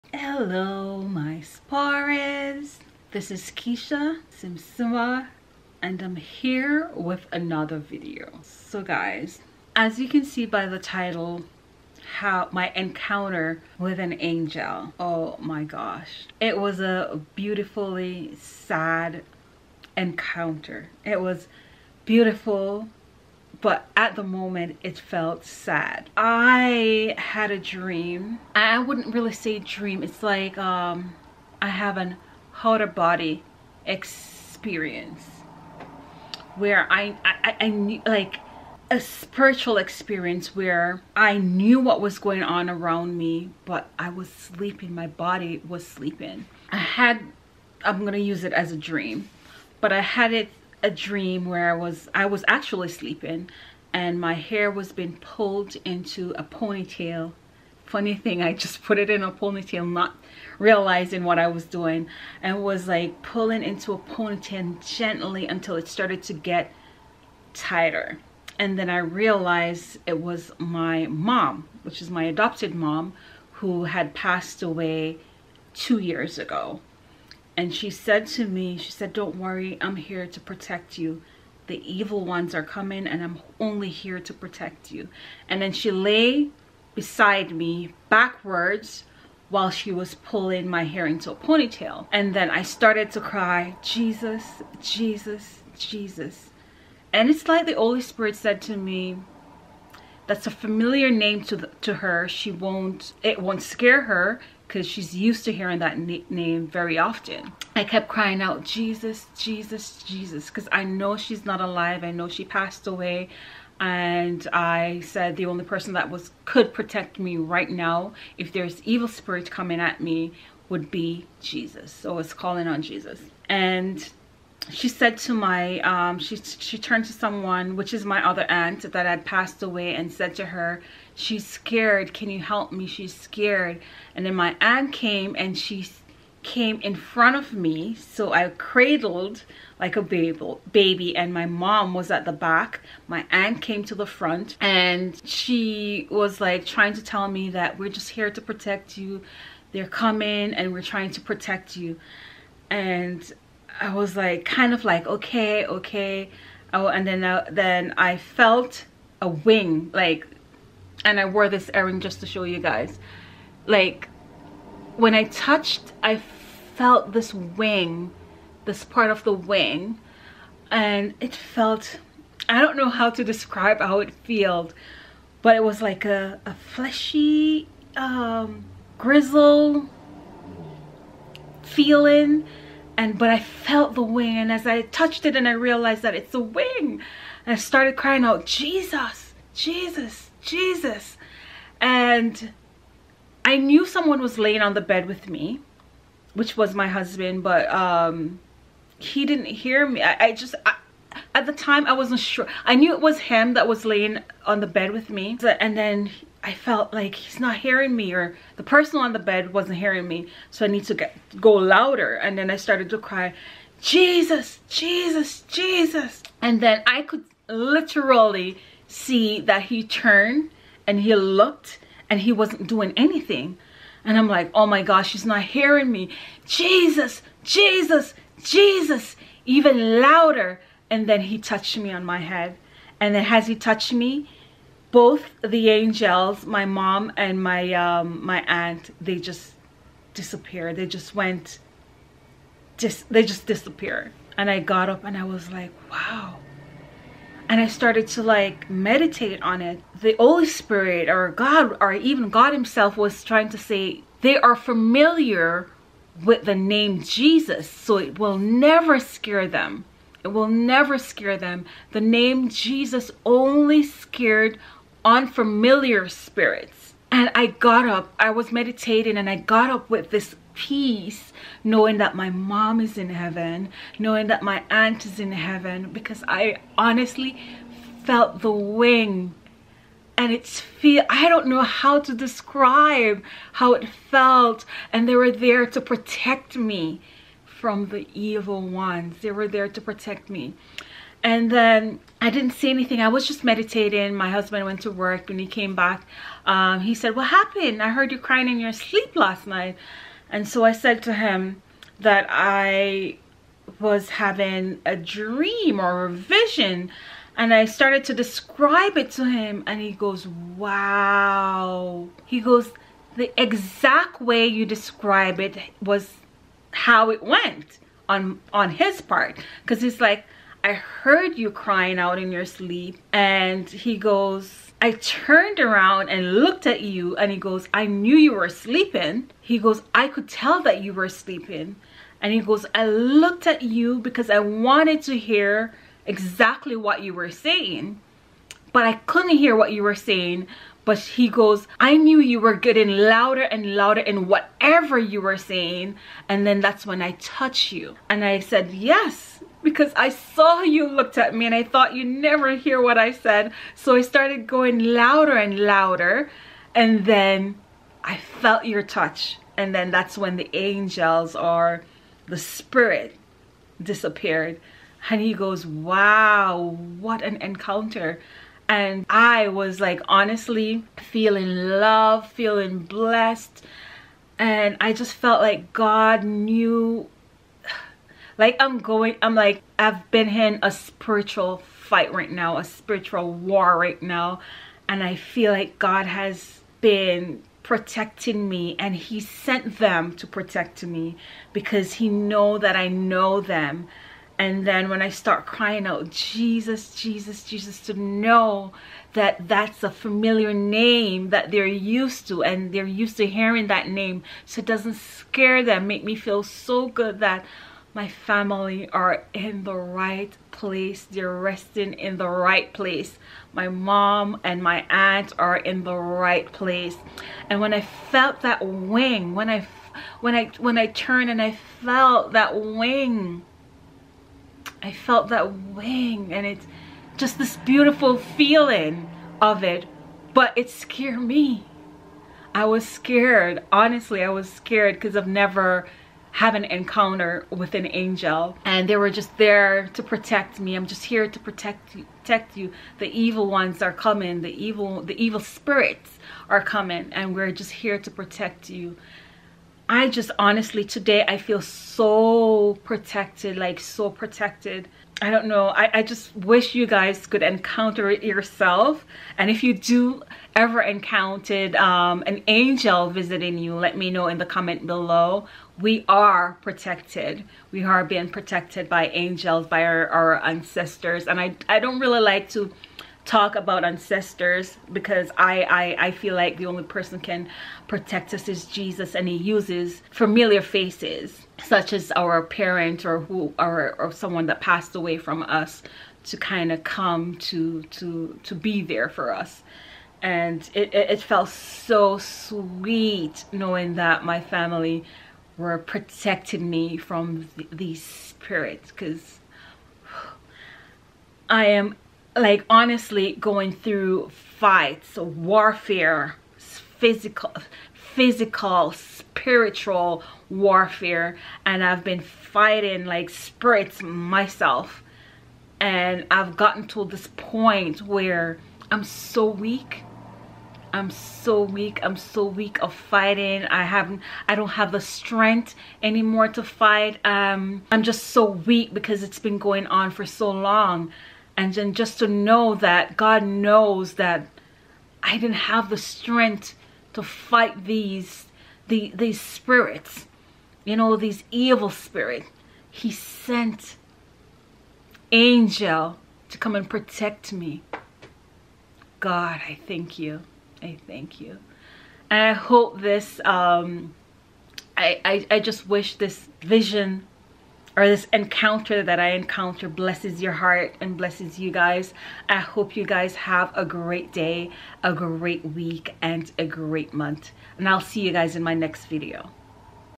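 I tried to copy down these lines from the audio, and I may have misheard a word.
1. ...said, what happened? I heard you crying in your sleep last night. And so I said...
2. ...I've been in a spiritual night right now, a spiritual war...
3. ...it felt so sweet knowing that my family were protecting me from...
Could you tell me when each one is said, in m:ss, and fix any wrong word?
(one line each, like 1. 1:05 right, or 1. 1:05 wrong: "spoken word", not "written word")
1. 4:56 right
2. 6:19 wrong: "fight", not "night"
3. 8:11 right.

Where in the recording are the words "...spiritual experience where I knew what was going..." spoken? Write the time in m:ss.
0:38.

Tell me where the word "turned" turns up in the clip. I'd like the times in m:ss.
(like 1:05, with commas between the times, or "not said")
2:06, 3:39, 5:24, 7:00.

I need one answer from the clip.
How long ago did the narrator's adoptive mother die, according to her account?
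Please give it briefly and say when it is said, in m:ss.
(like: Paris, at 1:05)
2 years, at 1:15.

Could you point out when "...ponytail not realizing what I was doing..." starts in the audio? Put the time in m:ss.
0:59.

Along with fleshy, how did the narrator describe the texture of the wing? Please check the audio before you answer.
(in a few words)
Grizzle.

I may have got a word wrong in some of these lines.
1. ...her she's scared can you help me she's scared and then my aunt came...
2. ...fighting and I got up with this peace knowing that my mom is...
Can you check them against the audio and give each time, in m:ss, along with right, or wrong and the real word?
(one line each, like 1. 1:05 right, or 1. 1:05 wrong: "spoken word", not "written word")
1. 2:10 right
2. 4:28 wrong: "meditating", not "fighting".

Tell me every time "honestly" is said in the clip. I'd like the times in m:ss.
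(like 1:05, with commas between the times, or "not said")
4:36, 6:10, 7:13, 7:30, 8:22.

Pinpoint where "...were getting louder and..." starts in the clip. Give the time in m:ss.
5:42.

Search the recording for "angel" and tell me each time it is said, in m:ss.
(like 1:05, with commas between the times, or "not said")
0:14, 3:55, 6:00, 7:17, 7:42, 7:49, 9:05.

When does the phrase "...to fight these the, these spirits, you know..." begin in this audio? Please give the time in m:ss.
8:57.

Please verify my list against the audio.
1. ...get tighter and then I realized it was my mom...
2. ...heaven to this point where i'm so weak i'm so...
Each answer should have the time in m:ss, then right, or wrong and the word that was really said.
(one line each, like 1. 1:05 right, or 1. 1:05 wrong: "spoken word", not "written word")
1. 1:06 right
2. 8:36 wrong: "gotten", not "heaven".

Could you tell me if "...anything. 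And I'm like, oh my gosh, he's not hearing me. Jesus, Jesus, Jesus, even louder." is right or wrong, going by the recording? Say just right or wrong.
right.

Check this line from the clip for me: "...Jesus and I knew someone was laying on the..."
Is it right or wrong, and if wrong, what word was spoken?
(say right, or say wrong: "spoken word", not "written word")
right.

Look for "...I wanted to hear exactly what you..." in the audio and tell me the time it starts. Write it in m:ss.
5:34.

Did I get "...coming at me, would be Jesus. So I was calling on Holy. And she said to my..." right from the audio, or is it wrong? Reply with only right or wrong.
wrong.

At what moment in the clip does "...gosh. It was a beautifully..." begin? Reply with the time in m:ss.
0:15.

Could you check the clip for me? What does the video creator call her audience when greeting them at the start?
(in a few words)
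Sparies.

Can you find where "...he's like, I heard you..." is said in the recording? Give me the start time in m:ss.
5:19.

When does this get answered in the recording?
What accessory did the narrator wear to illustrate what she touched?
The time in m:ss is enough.
2:41.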